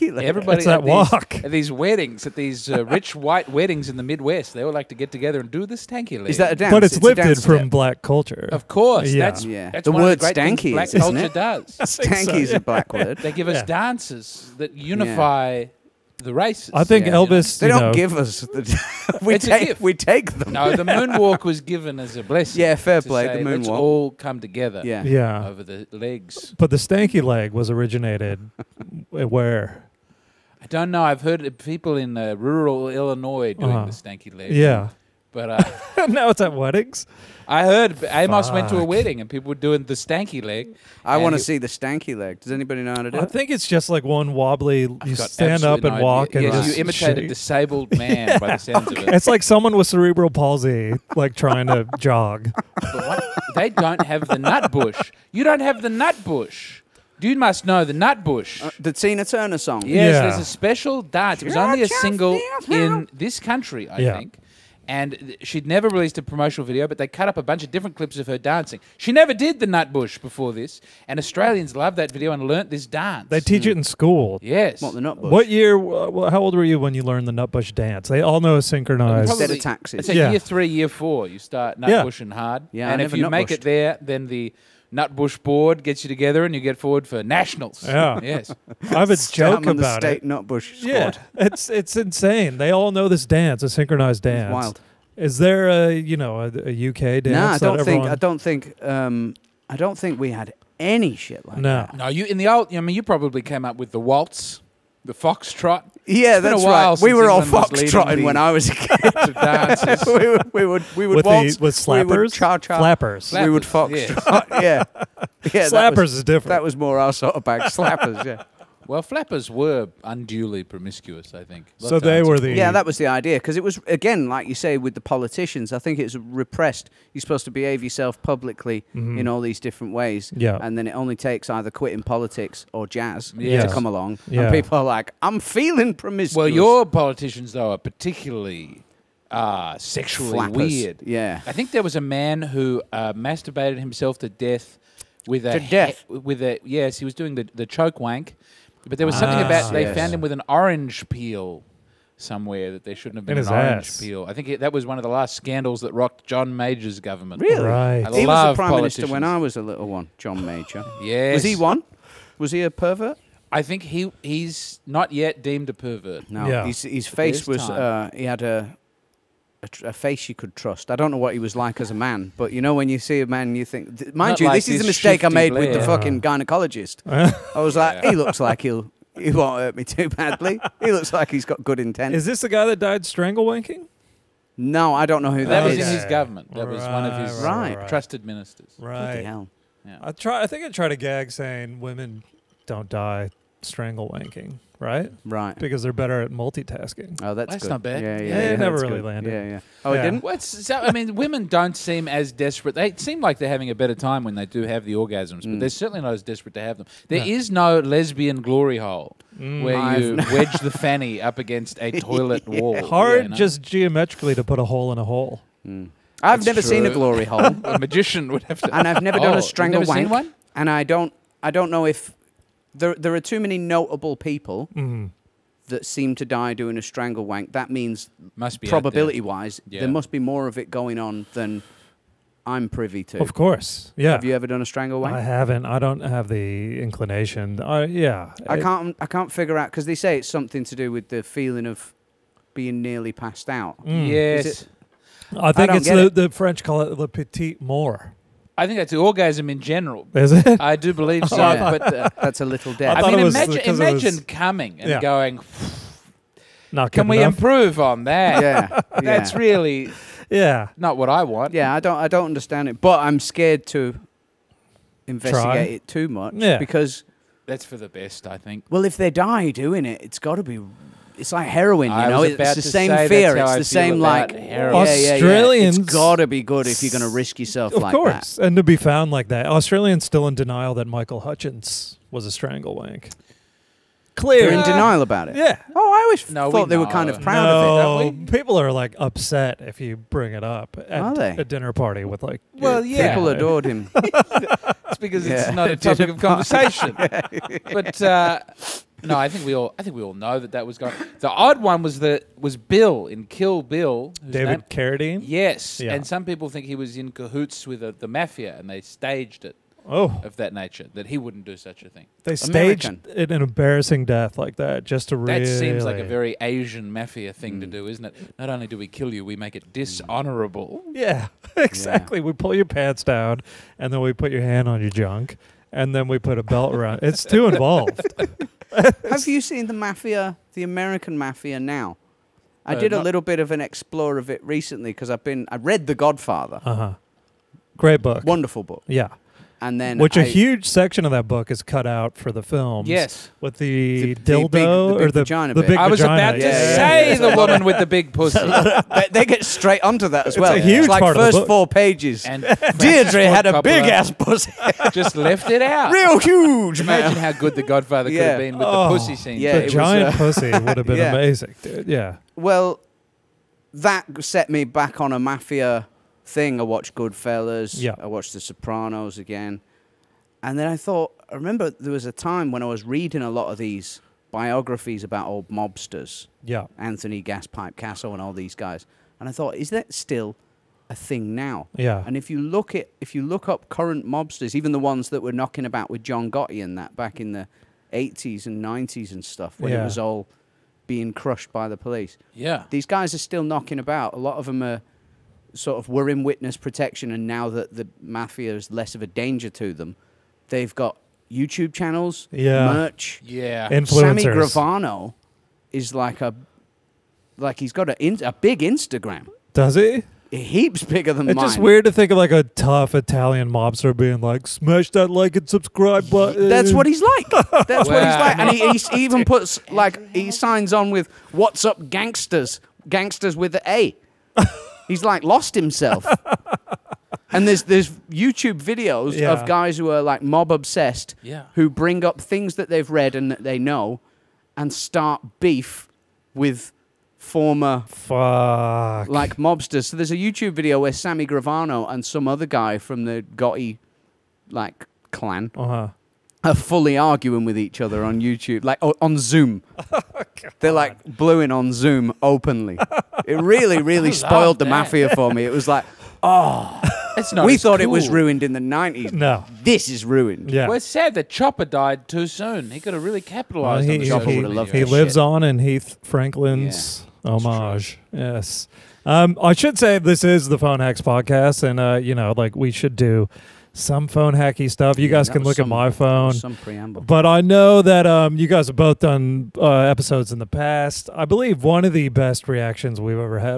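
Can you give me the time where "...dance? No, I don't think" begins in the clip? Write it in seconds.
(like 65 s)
97 s.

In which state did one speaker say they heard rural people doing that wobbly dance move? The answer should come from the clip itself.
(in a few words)
Illinois.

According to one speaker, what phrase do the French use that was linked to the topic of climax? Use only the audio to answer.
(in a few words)
Le petit mort.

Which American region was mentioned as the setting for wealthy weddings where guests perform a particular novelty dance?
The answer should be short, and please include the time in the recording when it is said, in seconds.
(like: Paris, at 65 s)
The Midwest, at 3 s.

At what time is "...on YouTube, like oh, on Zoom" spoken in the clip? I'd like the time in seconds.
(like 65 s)
448 s.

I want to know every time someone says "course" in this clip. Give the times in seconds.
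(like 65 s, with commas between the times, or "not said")
8 s, 233 s, 277 s.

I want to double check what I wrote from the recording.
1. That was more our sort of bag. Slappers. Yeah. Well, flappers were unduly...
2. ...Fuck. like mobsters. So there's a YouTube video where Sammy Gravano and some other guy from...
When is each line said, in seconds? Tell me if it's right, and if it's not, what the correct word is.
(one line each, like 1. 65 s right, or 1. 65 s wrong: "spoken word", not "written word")
1. 116 s right
2. 437 s right.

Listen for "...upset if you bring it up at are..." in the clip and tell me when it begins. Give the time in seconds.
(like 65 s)
288 s.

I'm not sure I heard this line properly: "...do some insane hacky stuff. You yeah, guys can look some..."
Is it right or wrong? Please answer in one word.
wrong.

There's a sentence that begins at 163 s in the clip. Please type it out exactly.
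I think he he's not yet deemed a pervert.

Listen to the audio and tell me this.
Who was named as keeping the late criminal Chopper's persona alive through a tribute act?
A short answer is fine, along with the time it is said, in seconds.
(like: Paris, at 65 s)
Heath Franklin, at 465 s.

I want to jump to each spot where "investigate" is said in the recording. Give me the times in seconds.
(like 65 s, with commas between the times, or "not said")
265 s.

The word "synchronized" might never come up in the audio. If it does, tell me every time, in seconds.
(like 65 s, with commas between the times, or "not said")
78 s, 93 s.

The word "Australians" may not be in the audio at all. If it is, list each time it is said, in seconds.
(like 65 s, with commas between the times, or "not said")
71 s, 274 s, 279 s.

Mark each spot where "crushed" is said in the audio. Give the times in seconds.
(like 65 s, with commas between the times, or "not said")
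391 s.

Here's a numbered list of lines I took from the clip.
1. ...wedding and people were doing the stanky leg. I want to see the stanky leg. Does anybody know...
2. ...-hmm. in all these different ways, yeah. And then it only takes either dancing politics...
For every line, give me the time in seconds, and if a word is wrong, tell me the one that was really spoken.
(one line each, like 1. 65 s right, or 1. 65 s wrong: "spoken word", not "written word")
1. 38 s right
2. 129 s wrong: "quitting", not "dancing".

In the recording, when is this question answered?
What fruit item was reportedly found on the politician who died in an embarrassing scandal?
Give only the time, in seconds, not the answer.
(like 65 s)
150 s.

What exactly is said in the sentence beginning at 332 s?
I uh, did a little bit of an explore of it recently because I've been I read The Godfather.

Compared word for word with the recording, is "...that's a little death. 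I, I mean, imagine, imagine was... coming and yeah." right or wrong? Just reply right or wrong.
right.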